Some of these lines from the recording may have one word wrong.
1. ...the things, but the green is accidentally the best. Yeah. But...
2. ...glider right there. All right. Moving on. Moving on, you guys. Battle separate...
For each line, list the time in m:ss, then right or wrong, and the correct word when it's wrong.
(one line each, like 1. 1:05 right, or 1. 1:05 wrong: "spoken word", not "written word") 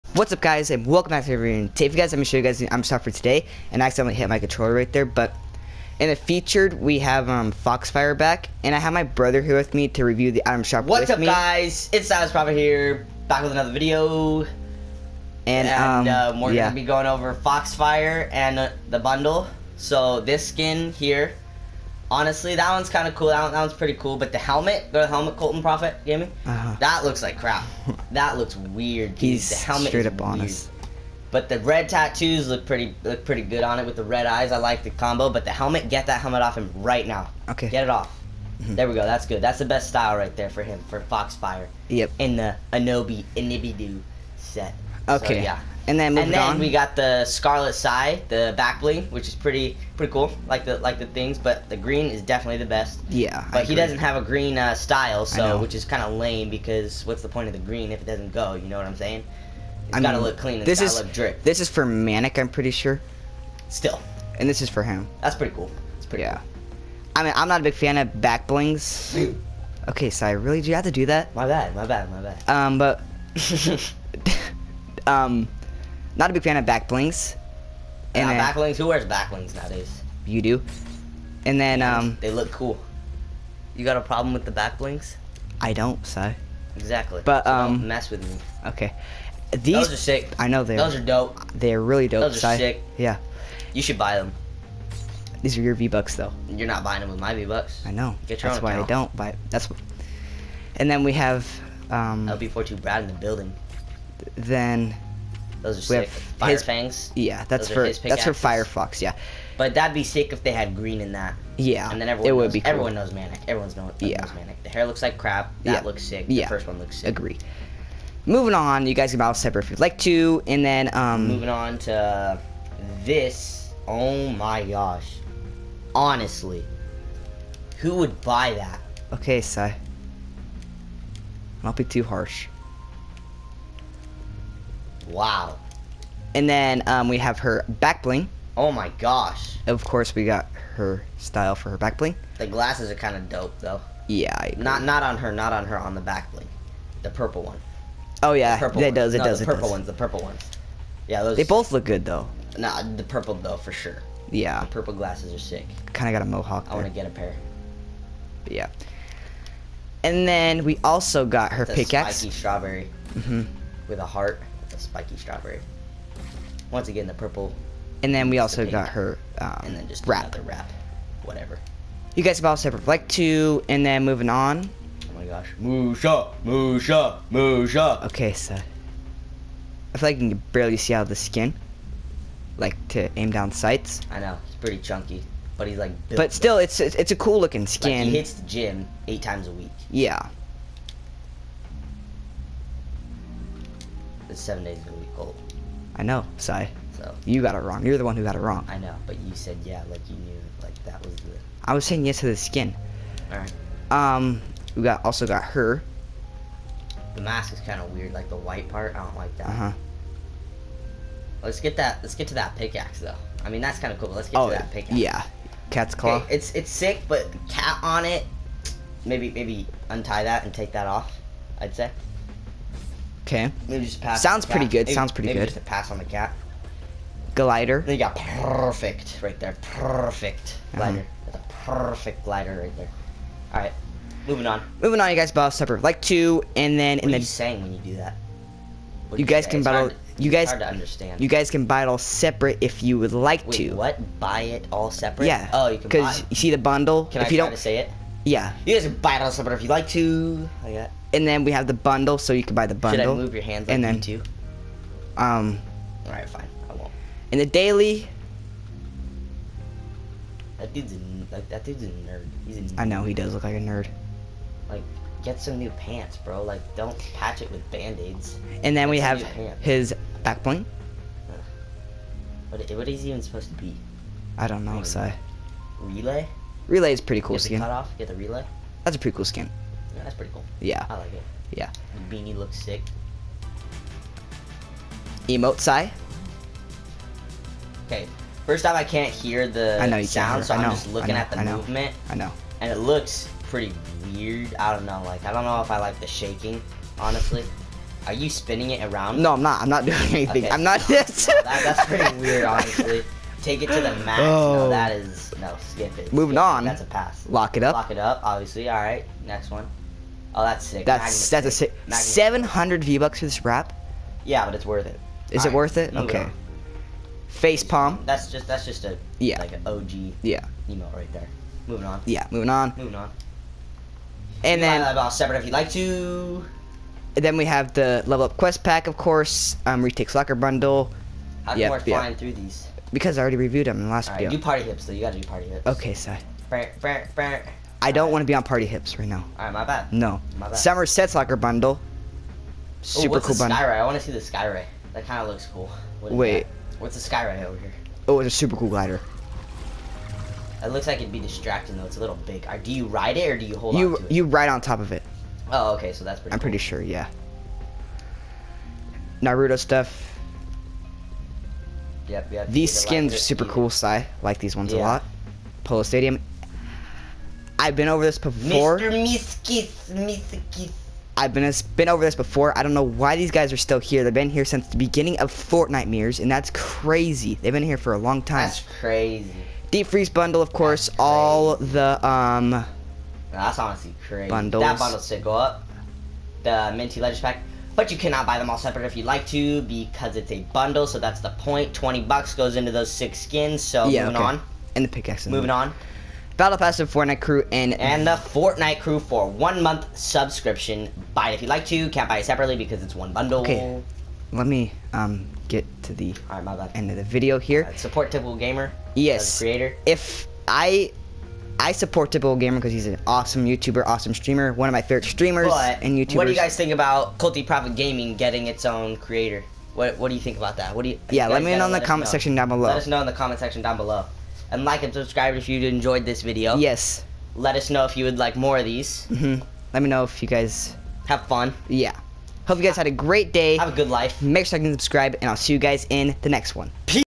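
1. 0:50 wrong: "definitely", not "accidentally"
2. 3:52 right.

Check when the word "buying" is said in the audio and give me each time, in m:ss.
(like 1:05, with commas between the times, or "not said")
1:36.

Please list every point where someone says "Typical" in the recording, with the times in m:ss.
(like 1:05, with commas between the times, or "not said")
6:48, 6:52.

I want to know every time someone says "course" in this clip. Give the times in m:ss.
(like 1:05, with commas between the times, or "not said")
2:19, 5:28, 6:20.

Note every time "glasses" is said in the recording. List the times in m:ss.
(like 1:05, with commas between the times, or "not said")
2:22, 2:34.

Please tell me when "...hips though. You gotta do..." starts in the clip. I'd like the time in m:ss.
5:34.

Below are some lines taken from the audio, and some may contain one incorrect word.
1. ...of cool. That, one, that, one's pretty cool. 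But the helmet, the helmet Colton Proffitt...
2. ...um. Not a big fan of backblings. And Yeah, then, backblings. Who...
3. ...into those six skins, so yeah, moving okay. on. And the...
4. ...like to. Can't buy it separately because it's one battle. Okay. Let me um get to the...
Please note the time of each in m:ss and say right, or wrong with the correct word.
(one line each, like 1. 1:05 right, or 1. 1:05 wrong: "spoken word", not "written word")
1. 0:23 right
2. 1:15 right
3. 6:32 right
4. 6:41 wrong: "bundle", not "battle".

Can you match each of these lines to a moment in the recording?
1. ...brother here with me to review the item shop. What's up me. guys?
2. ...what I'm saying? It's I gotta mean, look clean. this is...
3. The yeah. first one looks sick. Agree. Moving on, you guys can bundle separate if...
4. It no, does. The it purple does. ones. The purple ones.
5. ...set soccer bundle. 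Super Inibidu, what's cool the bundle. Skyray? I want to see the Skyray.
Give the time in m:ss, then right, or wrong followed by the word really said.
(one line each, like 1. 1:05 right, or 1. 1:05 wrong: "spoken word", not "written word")
1. 0:09 right
2. 0:58 right
3. 1:56 wrong: "battle", not "bundle"
4. 2:29 right
5. 5:40 wrong: "Ooh", not "Inibidu".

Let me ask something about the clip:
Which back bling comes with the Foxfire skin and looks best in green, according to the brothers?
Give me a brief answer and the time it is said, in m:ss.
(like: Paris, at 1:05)
Scarlet Psy, at 0:47.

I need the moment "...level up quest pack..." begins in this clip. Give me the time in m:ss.
5:28.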